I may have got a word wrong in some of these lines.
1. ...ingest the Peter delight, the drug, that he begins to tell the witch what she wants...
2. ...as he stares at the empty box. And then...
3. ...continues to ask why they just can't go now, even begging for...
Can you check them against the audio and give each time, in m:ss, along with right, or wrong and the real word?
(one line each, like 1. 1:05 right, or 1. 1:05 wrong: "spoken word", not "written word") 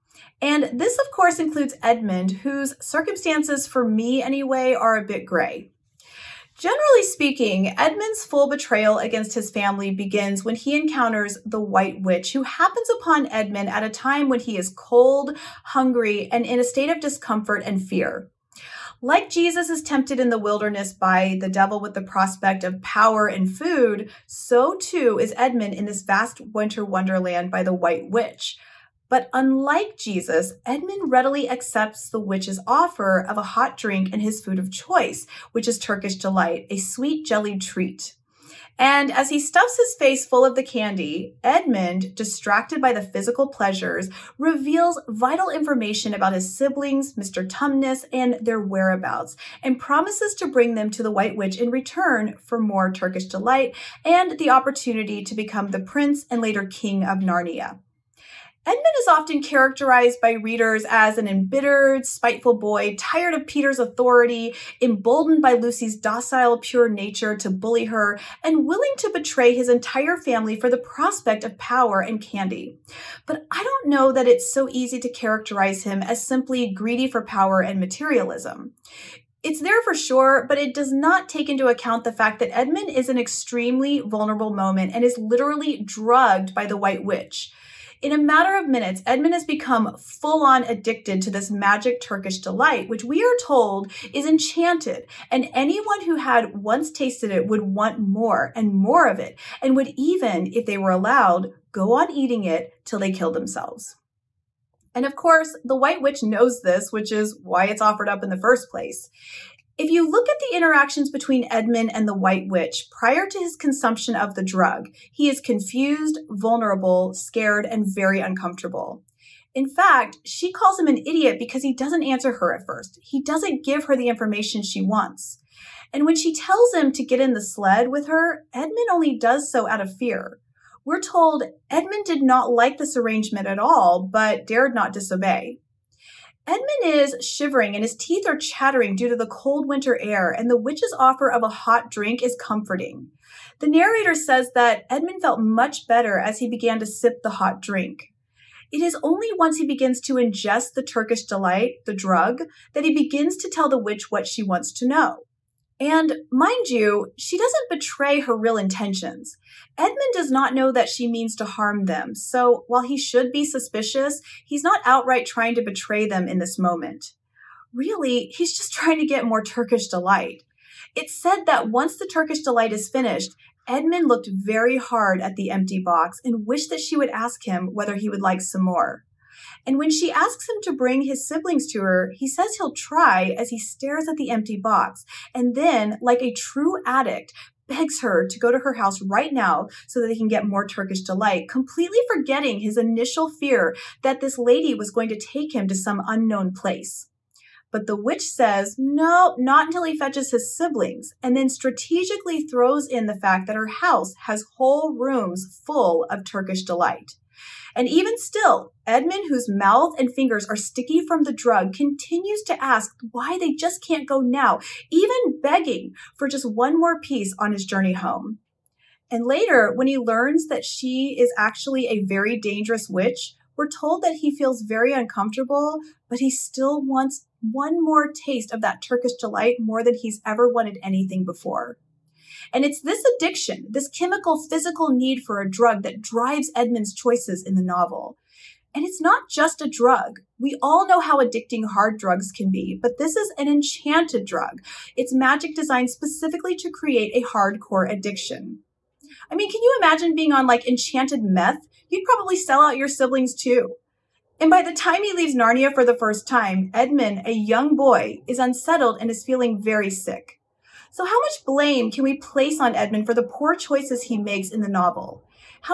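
1. 2:30 wrong: "Turkish", not "Peter"
2. 3:03 right
3. 3:31 right.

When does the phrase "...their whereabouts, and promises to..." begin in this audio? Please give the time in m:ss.
0:48.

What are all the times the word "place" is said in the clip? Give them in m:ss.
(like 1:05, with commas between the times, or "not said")
1:48, 3:16, 4:22.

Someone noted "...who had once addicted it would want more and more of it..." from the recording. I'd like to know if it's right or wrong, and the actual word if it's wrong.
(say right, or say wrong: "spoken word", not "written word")
wrong: "tasted", not "addicted".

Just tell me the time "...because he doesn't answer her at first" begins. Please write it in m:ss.
2:01.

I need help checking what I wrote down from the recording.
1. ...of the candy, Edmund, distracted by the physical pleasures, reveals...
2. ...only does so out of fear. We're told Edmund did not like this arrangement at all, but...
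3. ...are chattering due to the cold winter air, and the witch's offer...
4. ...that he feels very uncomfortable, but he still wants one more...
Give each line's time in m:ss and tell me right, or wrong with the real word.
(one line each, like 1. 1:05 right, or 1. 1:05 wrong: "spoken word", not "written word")
1. 0:40 right
2. 2:08 right
3. 2:18 right
4. 3:44 right.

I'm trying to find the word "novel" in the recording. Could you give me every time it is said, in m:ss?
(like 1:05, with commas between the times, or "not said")
3:57, 4:24.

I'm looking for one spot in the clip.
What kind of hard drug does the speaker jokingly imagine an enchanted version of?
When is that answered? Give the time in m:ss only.
4:11.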